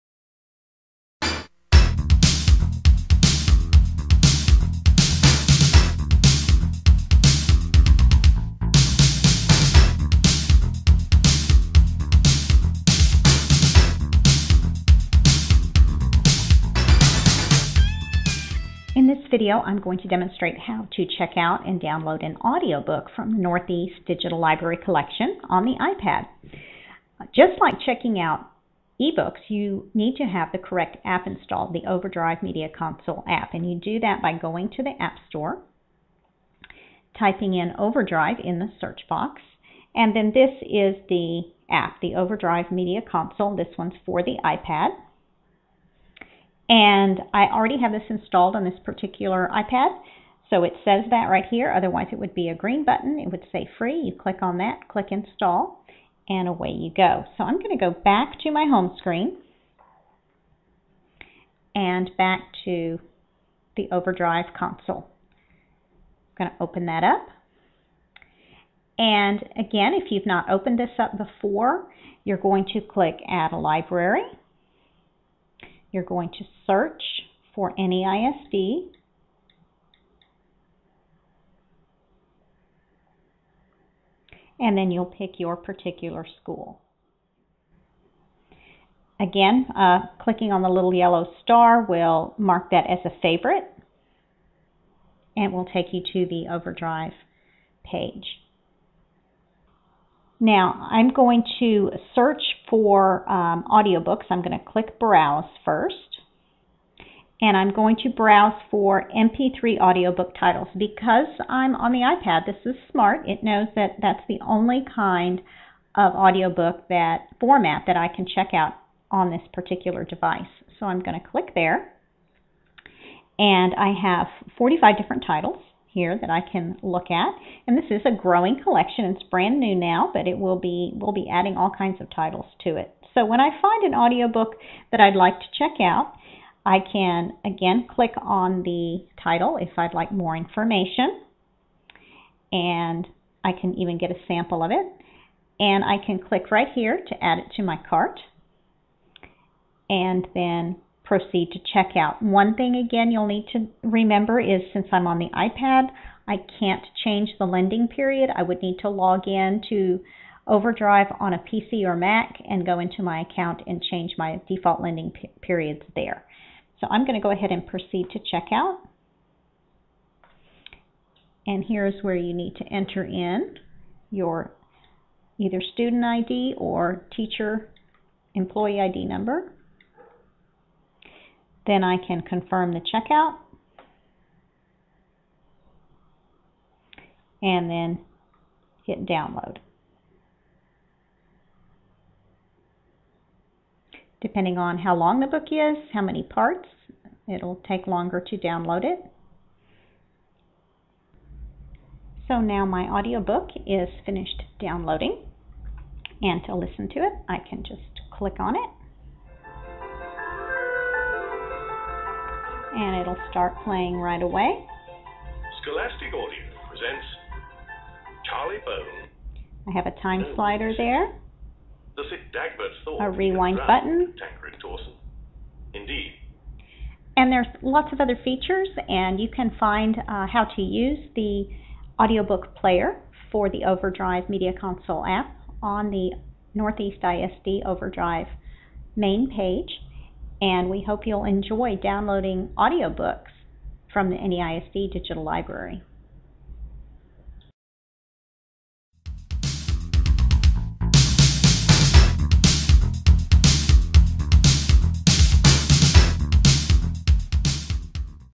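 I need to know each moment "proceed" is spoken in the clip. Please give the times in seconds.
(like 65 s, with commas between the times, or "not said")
151 s, 167 s.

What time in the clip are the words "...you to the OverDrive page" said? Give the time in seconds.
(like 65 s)
95 s.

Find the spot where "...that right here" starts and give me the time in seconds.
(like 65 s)
51 s.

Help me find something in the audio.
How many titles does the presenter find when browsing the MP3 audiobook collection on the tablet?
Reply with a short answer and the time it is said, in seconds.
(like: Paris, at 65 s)
45, at 124 s.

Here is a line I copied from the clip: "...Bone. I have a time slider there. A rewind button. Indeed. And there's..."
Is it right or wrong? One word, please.
right.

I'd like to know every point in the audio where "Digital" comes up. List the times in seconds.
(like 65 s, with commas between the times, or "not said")
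24 s, 244 s.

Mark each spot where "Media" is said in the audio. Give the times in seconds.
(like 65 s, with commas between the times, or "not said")
32 s, 42 s, 234 s.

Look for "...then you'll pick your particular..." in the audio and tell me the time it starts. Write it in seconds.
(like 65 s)
84 s.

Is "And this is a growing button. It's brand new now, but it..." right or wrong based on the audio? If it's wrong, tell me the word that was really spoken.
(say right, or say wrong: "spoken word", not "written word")
wrong: "collection", not "button".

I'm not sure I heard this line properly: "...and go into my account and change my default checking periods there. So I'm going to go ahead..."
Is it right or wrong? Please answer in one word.
wrong.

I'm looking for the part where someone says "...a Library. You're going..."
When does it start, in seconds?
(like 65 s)
73 s.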